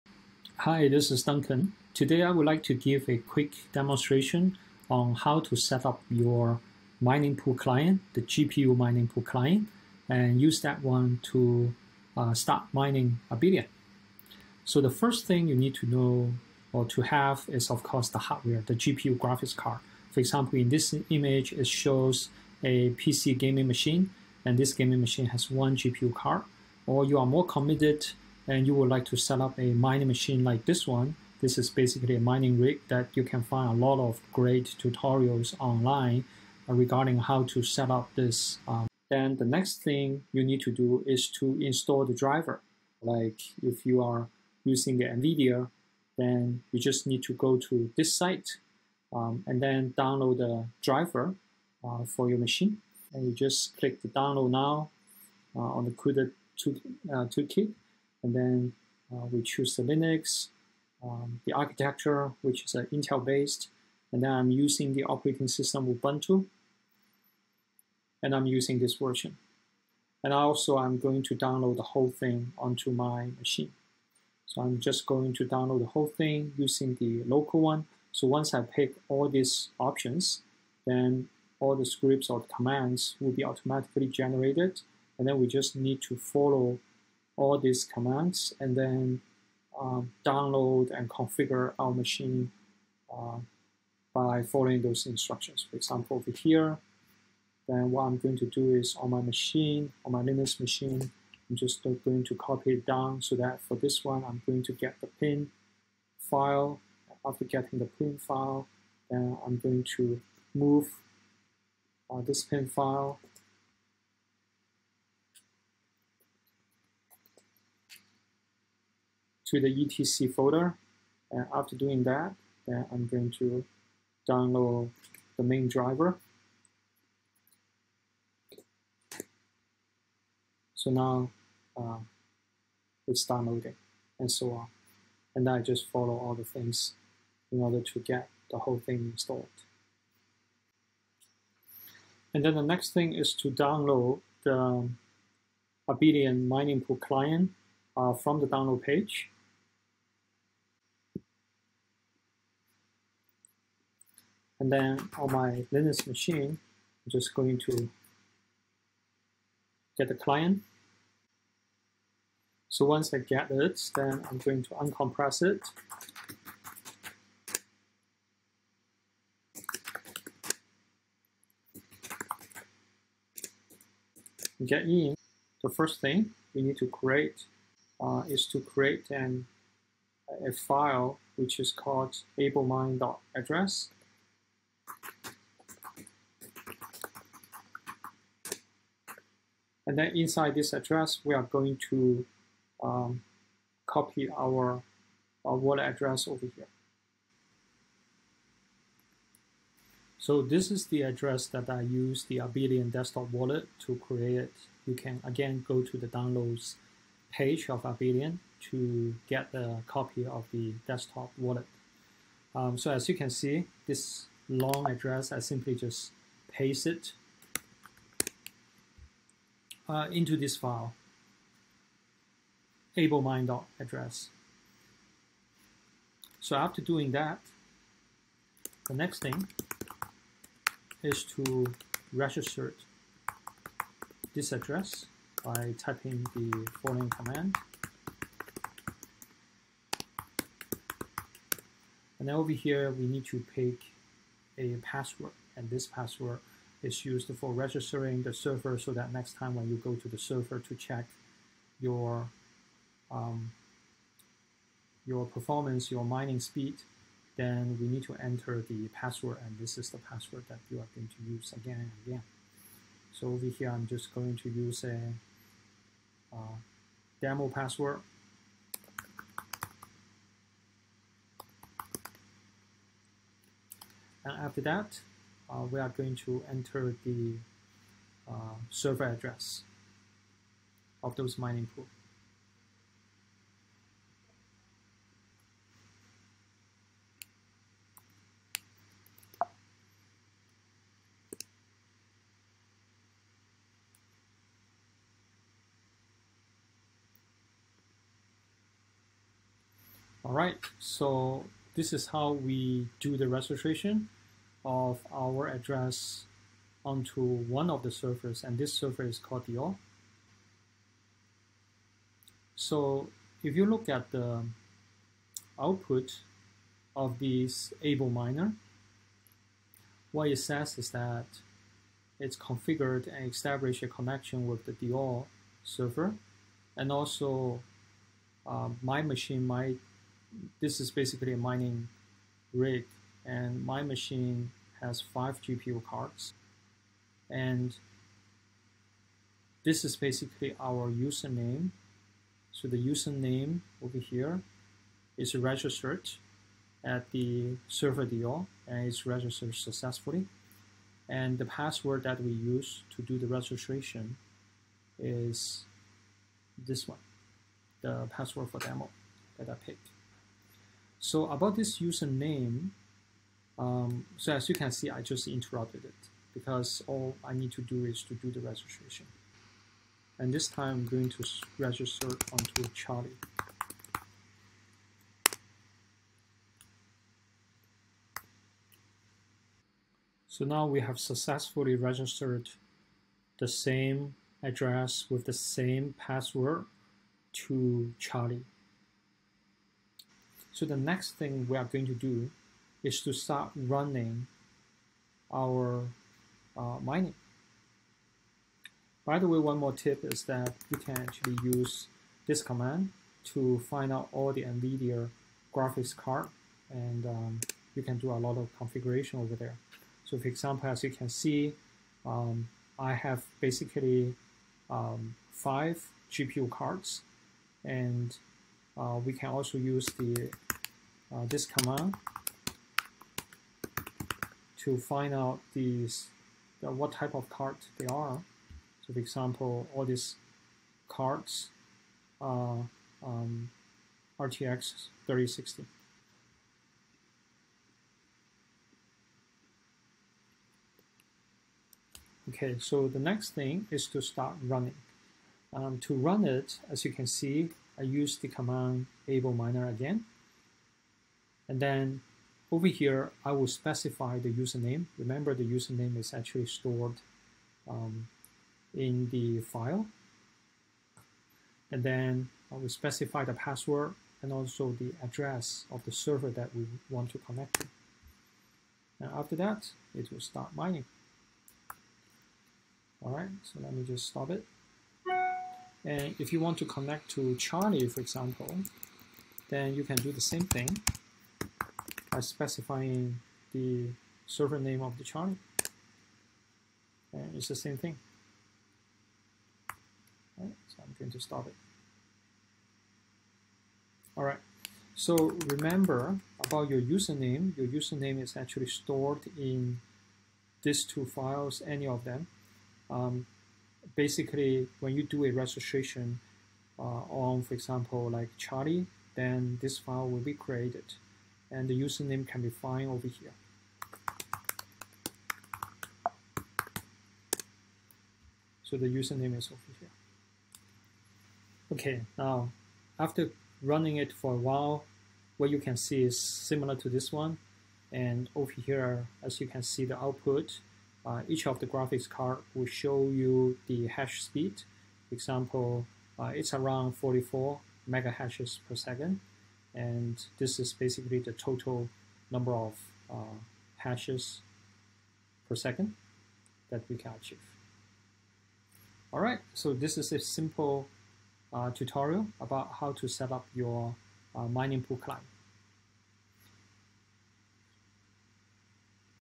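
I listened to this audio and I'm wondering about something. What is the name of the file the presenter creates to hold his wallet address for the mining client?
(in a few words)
ablemind.address.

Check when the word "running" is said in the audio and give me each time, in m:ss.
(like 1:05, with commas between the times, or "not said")
6:33, 7:24, 8:43.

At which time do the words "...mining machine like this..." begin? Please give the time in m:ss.
0:29.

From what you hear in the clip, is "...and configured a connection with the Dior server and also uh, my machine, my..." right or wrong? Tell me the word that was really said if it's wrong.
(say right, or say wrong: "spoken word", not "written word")
wrong: "established", not "configured".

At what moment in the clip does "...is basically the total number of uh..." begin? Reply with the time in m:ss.
9:00.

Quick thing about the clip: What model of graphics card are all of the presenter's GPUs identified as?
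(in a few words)
RTX 3060.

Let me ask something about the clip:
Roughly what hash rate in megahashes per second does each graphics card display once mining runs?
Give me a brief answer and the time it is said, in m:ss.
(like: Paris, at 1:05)
44, at 8:56.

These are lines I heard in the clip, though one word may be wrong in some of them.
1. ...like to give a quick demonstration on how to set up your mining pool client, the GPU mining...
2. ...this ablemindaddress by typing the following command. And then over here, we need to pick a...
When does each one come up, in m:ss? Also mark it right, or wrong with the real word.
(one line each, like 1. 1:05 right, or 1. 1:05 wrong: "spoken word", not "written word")
1. 0:02 right
2. 3:54 wrong: "address", not "ablemindaddress".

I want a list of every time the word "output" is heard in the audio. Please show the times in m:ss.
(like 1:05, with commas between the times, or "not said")
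5:15, 8:49.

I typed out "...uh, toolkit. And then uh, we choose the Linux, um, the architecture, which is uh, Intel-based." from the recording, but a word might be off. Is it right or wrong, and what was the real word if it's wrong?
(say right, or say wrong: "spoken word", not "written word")
right.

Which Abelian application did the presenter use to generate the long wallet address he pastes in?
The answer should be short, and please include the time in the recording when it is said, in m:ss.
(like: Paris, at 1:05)
Abelian desktop wallet, at 3:22.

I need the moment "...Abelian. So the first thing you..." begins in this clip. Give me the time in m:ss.
0:13.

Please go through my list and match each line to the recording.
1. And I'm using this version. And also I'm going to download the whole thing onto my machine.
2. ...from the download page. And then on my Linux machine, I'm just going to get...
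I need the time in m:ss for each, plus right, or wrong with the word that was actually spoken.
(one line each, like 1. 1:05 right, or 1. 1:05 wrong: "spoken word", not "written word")
1. 1:08 right
2. 2:28 right.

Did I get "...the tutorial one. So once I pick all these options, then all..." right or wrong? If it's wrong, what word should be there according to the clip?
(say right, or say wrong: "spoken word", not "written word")
wrong: "local", not "tutorial".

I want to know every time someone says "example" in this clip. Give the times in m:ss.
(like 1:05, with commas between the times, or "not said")
0:20, 1:35, 6:50, 7:08, 7:58, 8:27, 8:55.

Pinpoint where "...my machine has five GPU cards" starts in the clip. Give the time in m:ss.
5:33.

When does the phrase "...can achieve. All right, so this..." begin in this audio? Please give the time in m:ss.
9:06.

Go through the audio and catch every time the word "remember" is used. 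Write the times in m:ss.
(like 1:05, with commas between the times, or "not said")
7:34, 8:15.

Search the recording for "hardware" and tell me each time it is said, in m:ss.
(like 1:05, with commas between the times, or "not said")
0:18.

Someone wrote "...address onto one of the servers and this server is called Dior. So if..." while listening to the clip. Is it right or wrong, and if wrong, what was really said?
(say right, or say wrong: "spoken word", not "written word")
right.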